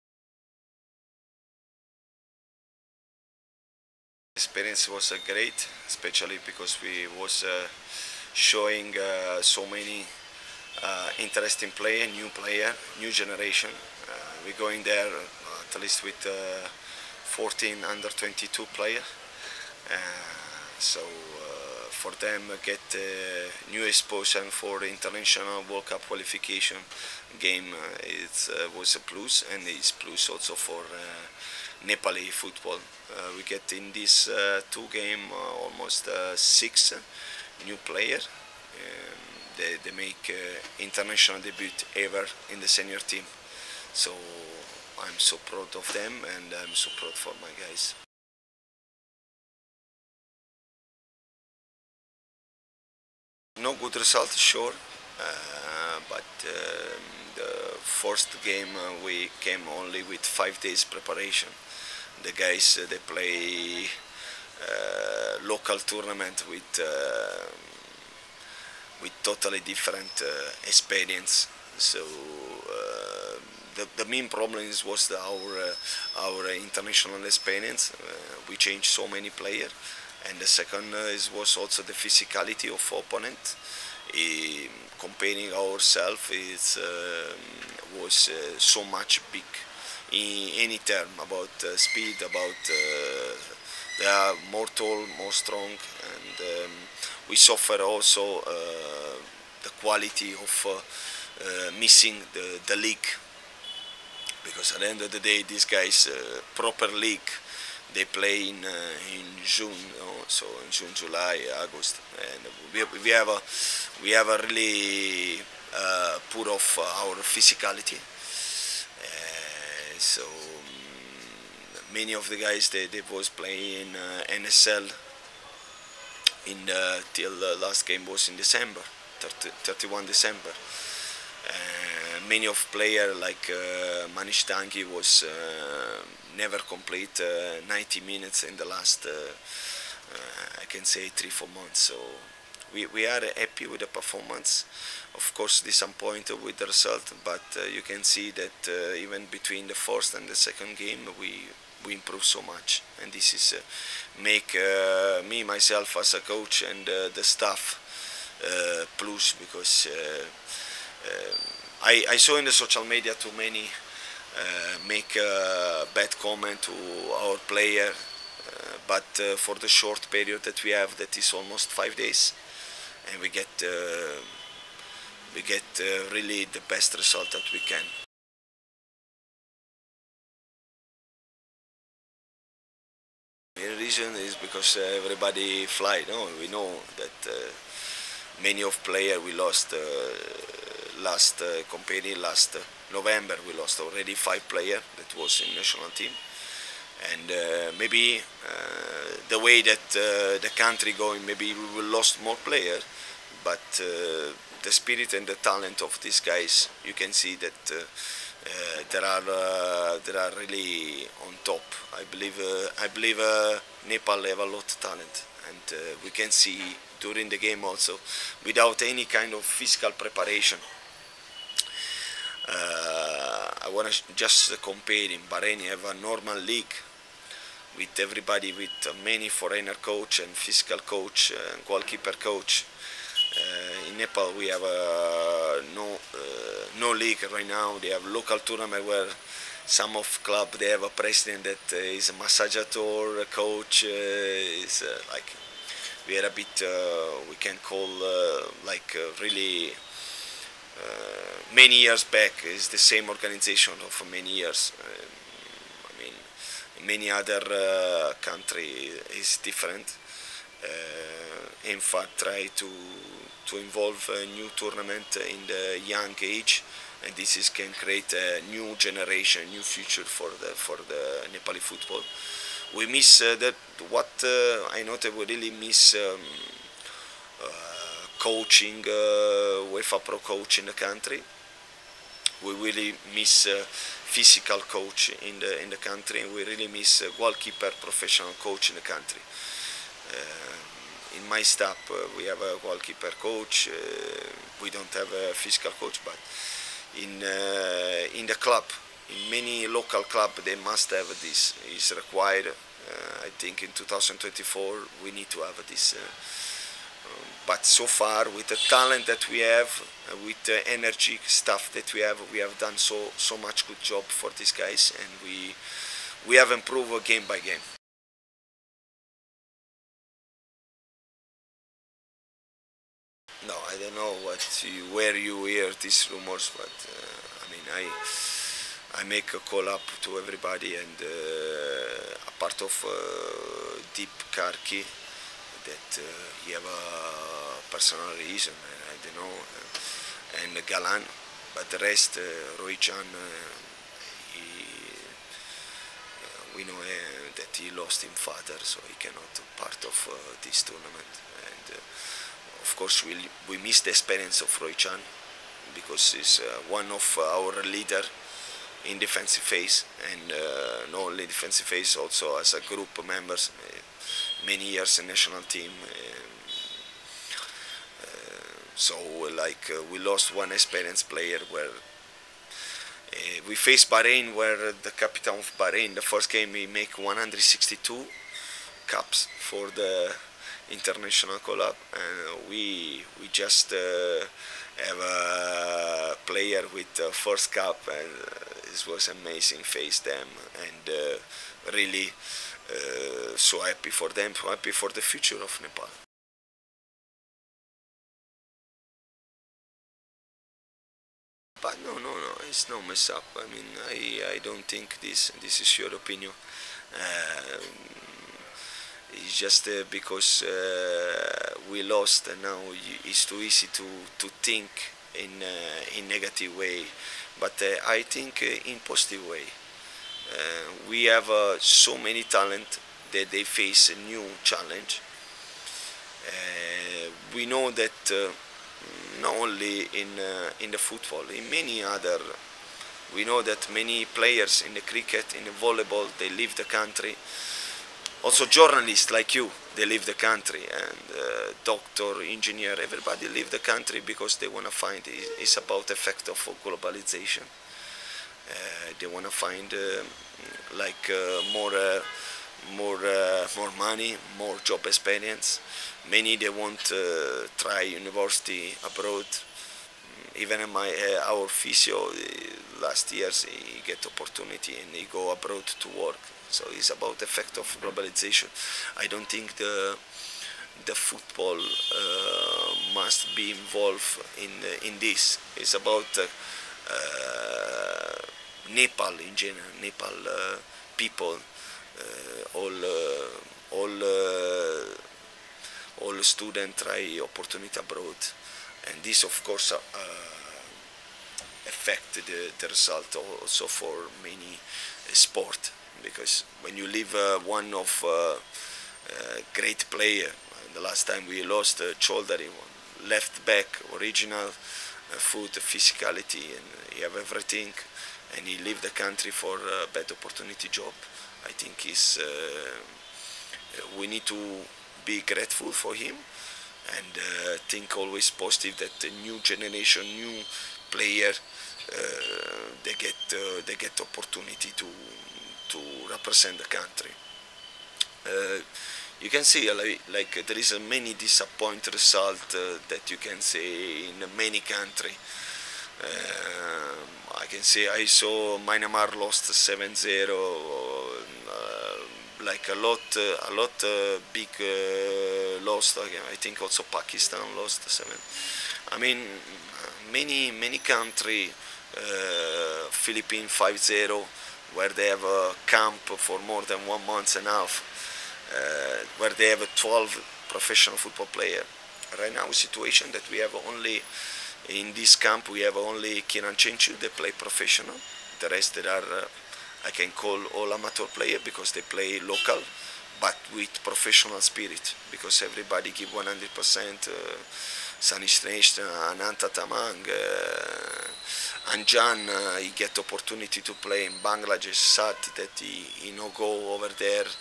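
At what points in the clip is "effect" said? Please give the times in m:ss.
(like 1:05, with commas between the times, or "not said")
7:25, 7:47.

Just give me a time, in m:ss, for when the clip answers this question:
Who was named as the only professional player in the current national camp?
9:26.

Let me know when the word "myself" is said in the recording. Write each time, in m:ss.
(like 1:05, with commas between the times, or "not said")
2:35.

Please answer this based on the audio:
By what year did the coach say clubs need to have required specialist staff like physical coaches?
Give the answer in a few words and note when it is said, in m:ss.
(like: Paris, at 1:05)
2024, at 5:03.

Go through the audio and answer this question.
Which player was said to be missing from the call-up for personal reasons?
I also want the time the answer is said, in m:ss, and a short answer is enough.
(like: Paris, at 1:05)
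Deep Karki, at 5:33.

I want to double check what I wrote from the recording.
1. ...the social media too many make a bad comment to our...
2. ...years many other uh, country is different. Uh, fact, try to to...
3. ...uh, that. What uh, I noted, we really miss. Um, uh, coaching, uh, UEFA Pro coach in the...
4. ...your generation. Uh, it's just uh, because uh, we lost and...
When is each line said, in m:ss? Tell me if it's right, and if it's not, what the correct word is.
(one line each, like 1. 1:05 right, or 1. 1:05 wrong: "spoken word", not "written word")
1. 2:42 right
2. 4:14 right
3. 4:33 right
4. 6:45 wrong: "opinion", not "generation".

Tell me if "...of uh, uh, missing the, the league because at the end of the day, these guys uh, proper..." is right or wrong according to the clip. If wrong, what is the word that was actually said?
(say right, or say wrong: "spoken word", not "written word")
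right.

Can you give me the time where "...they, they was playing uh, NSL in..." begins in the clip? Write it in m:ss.
2:02.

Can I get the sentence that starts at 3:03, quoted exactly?
The reason is because uh, everybody fly.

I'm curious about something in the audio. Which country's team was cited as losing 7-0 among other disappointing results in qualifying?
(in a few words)
Myanmar.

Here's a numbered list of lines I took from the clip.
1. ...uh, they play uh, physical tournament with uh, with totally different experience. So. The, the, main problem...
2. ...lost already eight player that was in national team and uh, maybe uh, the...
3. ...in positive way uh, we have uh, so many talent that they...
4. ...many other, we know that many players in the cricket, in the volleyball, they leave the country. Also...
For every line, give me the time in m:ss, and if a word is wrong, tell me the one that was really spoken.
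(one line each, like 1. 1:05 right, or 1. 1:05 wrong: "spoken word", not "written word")
1. 1:02 wrong: "local", not "physical"
2. 3:13 wrong: "five", not "eight"
3. 6:58 right
4. 7:11 right.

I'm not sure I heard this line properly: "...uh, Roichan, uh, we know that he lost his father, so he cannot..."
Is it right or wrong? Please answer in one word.
right.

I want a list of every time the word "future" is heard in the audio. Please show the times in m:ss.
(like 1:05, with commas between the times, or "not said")
4:29, 6:35.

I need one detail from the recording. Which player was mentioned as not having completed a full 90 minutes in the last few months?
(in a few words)
Manish Dangi.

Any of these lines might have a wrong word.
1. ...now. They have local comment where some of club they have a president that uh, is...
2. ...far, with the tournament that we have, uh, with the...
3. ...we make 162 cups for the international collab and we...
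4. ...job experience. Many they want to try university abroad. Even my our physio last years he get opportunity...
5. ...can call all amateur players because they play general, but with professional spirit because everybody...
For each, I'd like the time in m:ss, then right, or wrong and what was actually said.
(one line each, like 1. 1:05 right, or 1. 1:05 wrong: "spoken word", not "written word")
1. 3:57 wrong: "tournament", not "comment"
2. 5:07 wrong: "talent", not "tournament"
3. 6:16 right
4. 7:34 right
5. 9:29 wrong: "local", not "general".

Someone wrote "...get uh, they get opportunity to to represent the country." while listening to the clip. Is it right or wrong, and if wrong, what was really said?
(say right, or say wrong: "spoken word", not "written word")
right.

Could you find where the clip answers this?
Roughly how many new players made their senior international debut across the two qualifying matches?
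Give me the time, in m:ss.
0:36.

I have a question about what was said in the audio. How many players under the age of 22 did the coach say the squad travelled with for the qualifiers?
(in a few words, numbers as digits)
14.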